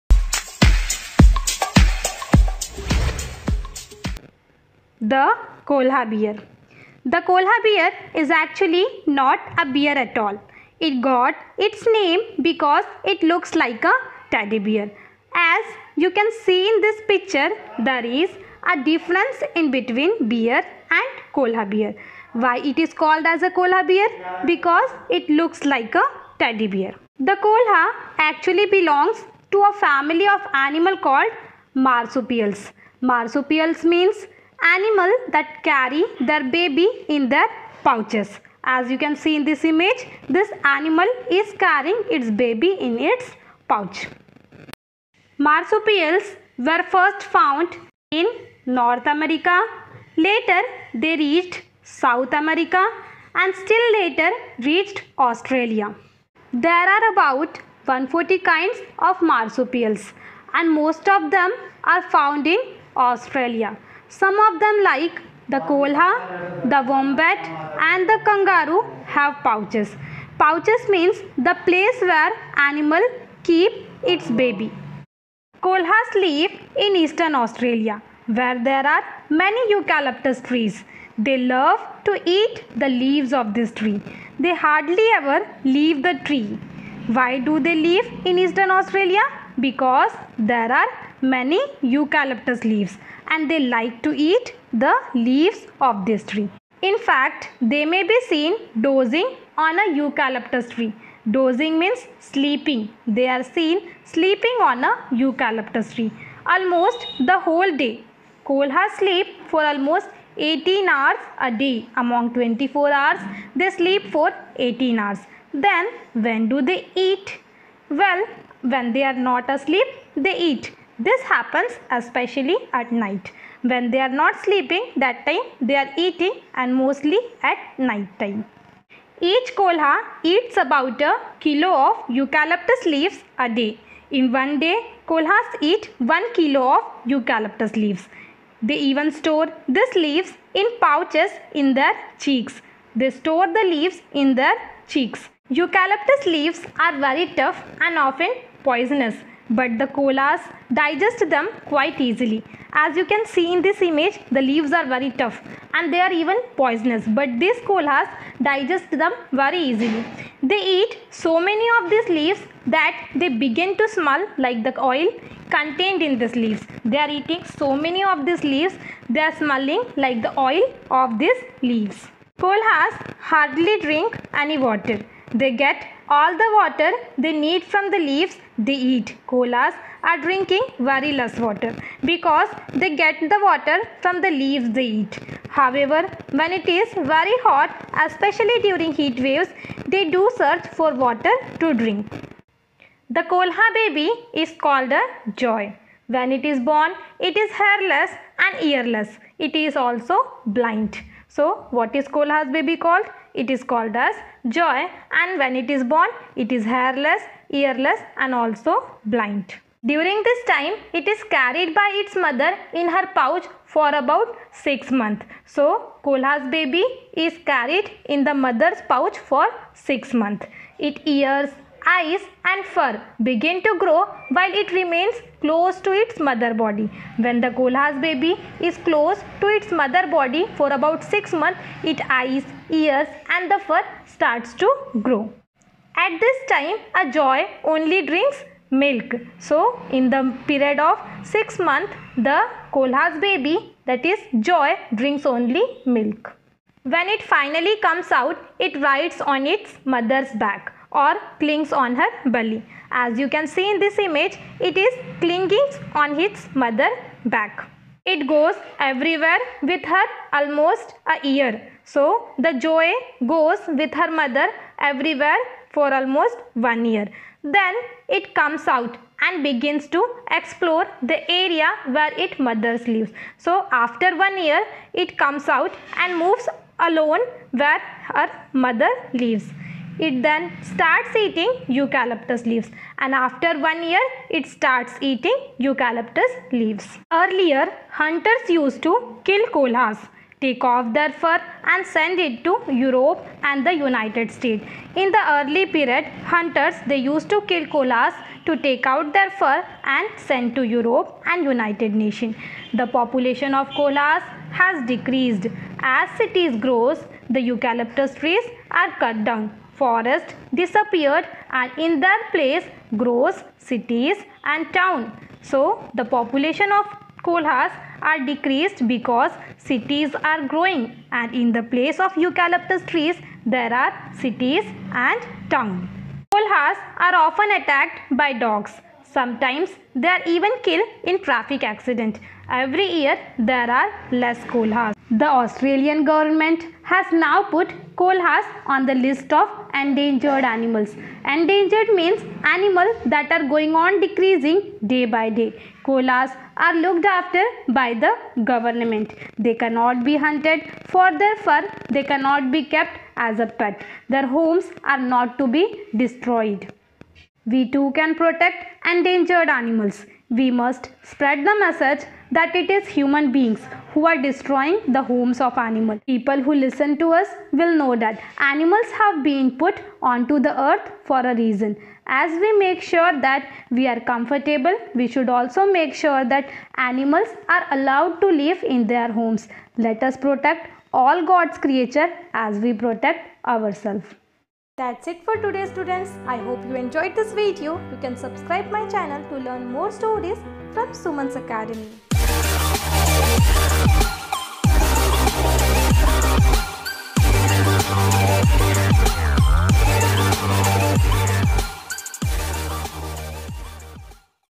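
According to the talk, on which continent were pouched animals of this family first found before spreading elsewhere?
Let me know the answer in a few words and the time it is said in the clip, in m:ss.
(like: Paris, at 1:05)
North America, at 0:48.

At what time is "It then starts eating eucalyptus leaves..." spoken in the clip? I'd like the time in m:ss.
4:39.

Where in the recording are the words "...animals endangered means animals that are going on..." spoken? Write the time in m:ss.
5:40.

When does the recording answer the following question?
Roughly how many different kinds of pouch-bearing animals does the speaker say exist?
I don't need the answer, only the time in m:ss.
0:57.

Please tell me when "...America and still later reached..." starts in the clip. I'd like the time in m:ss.
0:52.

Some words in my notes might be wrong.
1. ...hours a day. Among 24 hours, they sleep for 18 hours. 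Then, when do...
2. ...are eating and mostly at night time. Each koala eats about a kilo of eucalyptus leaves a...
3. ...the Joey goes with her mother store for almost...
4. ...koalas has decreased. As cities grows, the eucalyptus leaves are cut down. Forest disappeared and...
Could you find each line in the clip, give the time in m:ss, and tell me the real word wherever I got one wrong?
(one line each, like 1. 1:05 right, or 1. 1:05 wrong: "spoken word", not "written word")
1. 1:50 right
2. 2:05 right
3. 4:22 wrong: "everywhere", not "store"
4. 5:03 wrong: "trees", not "leaves".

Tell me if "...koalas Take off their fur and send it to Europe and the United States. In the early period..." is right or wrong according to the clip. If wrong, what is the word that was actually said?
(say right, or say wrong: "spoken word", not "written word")
right.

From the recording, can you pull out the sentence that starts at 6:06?
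People who listen to us will know that animals have been put onto the earth for a reason.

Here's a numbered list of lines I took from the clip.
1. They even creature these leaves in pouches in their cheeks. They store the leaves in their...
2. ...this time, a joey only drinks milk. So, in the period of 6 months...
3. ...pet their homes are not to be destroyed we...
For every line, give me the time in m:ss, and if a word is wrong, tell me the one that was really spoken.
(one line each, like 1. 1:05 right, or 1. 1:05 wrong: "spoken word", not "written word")
1. 2:18 wrong: "store", not "creature"
2. 3:56 right
3. 5:53 right.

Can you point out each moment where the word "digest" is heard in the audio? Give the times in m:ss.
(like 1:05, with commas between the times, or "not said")
2:30, 2:38.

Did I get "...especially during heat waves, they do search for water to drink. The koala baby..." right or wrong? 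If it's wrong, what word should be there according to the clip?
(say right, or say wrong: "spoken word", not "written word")
right.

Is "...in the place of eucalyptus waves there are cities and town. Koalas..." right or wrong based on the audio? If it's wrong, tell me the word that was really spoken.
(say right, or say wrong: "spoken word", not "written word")
wrong: "trees", not "waves".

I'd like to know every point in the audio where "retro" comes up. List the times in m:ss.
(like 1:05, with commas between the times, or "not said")
not said.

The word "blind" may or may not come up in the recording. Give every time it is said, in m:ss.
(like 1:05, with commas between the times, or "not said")
3:20, 3:29.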